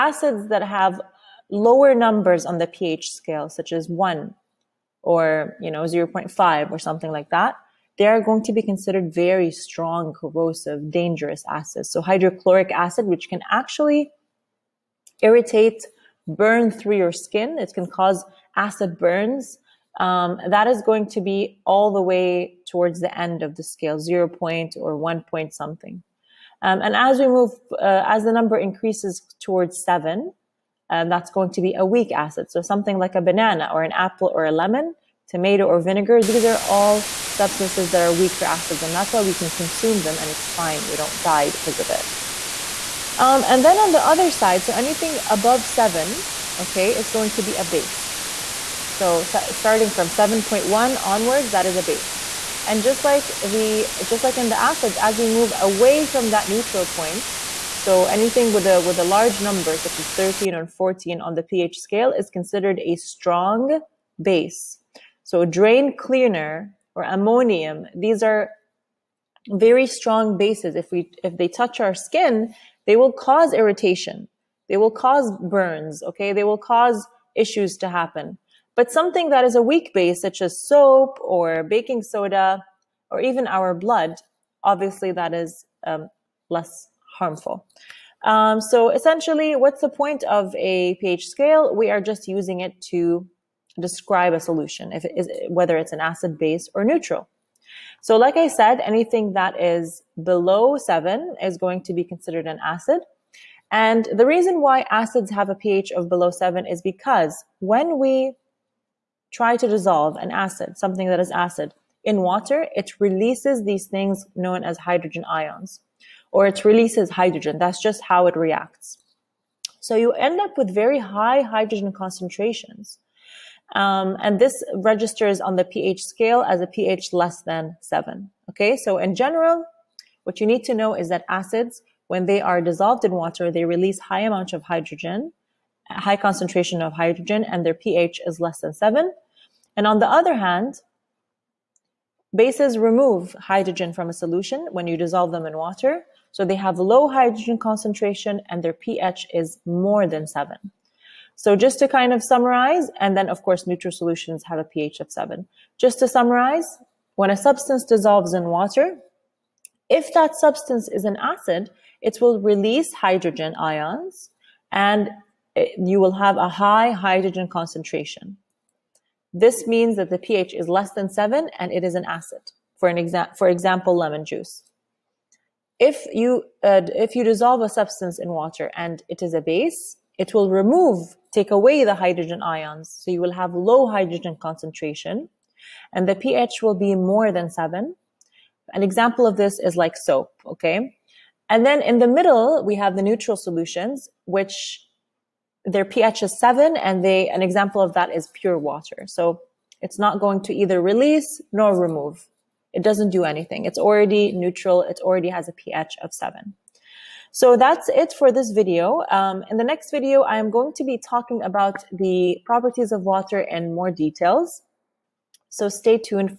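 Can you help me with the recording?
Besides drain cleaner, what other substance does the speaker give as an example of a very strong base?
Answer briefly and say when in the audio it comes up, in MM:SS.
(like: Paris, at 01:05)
Ammonium, at 01:07.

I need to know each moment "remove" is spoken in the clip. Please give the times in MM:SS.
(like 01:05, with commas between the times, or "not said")
02:22, 03:00, 03:21.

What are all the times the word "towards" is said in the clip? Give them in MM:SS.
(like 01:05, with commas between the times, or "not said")
00:22, 00:29.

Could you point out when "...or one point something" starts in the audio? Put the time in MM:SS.
00:24.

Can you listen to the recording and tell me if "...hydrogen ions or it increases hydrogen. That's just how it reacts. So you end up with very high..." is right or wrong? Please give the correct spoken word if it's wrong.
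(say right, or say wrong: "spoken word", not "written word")
wrong: "releases", not "increases".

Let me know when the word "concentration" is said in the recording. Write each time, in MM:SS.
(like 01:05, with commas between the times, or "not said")
02:01, 02:16, 02:27, 02:47, 03:04.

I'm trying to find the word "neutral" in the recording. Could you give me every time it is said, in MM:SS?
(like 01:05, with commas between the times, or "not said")
00:56, 01:36, 02:33, 03:13, 03:24.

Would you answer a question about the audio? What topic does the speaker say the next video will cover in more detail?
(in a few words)
Properties of water.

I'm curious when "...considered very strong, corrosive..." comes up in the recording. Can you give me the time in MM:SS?
00:08.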